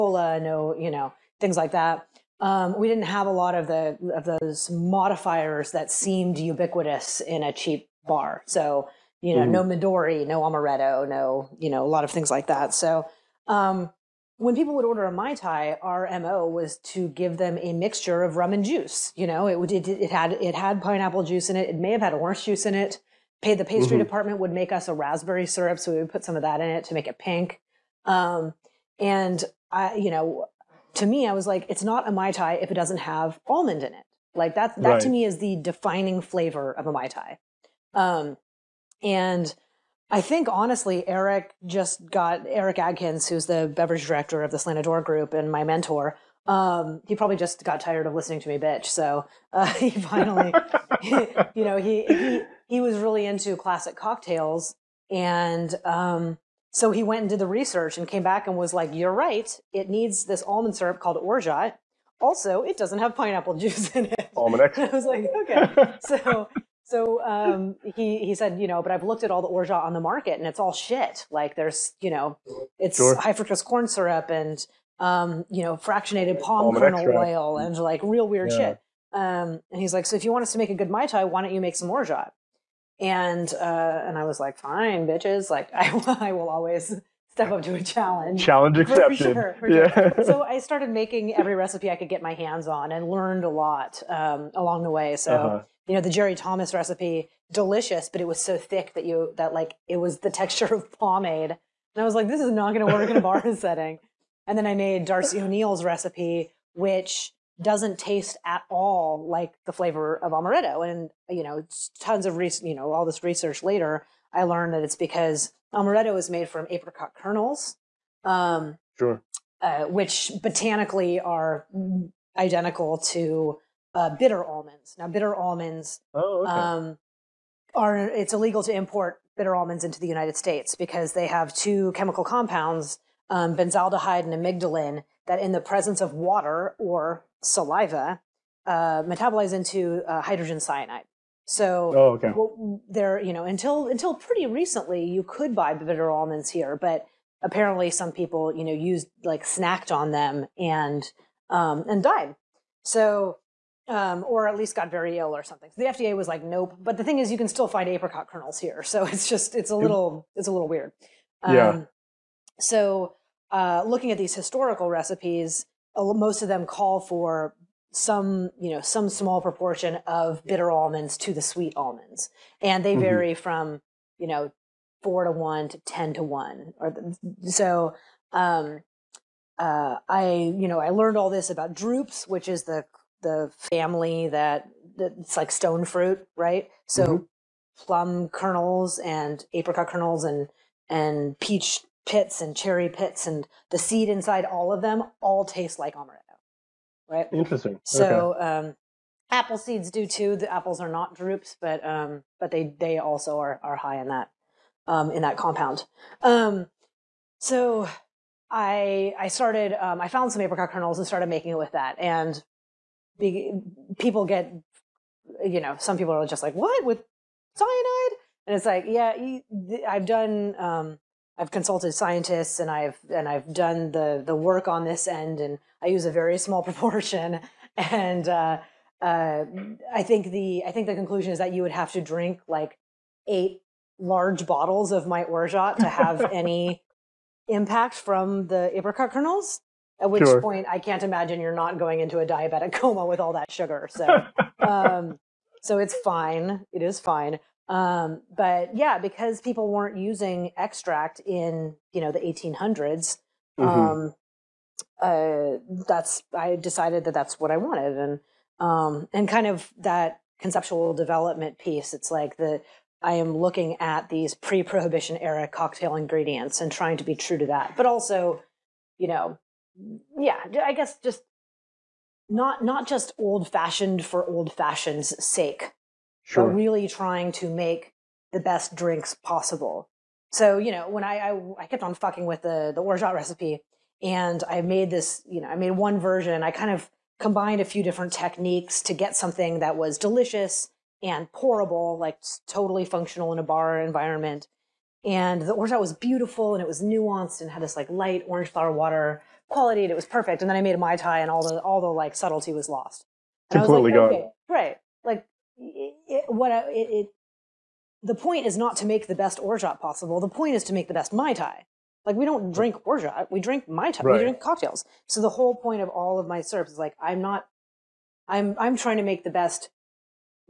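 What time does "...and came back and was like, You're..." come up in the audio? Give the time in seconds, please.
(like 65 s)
57 s.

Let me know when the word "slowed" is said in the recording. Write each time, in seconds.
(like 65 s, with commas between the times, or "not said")
not said.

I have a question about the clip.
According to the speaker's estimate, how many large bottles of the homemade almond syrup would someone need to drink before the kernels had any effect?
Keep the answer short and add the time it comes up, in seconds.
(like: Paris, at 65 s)
8, at 233 s.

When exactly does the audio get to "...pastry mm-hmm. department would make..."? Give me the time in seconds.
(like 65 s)
23 s.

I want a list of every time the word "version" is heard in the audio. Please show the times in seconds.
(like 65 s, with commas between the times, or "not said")
285 s.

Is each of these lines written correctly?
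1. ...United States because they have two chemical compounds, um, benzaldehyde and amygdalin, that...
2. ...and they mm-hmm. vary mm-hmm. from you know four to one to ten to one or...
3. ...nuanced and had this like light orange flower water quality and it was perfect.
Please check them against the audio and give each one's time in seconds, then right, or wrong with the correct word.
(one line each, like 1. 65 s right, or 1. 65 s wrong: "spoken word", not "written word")
1. 130 s right
2. 172 s right
3. 296 s right.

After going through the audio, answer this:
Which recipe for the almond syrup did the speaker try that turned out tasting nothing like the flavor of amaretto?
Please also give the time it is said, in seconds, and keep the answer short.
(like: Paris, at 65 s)
Darcy O'Neil's, at 105 s.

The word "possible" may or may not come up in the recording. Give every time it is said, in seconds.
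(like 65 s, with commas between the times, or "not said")
279 s, 309 s.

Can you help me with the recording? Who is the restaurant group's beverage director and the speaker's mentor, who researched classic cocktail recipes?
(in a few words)
Eric Adkins.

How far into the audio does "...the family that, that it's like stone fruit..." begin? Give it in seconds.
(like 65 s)
183 s.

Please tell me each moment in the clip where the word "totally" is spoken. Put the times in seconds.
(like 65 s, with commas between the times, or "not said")
292 s.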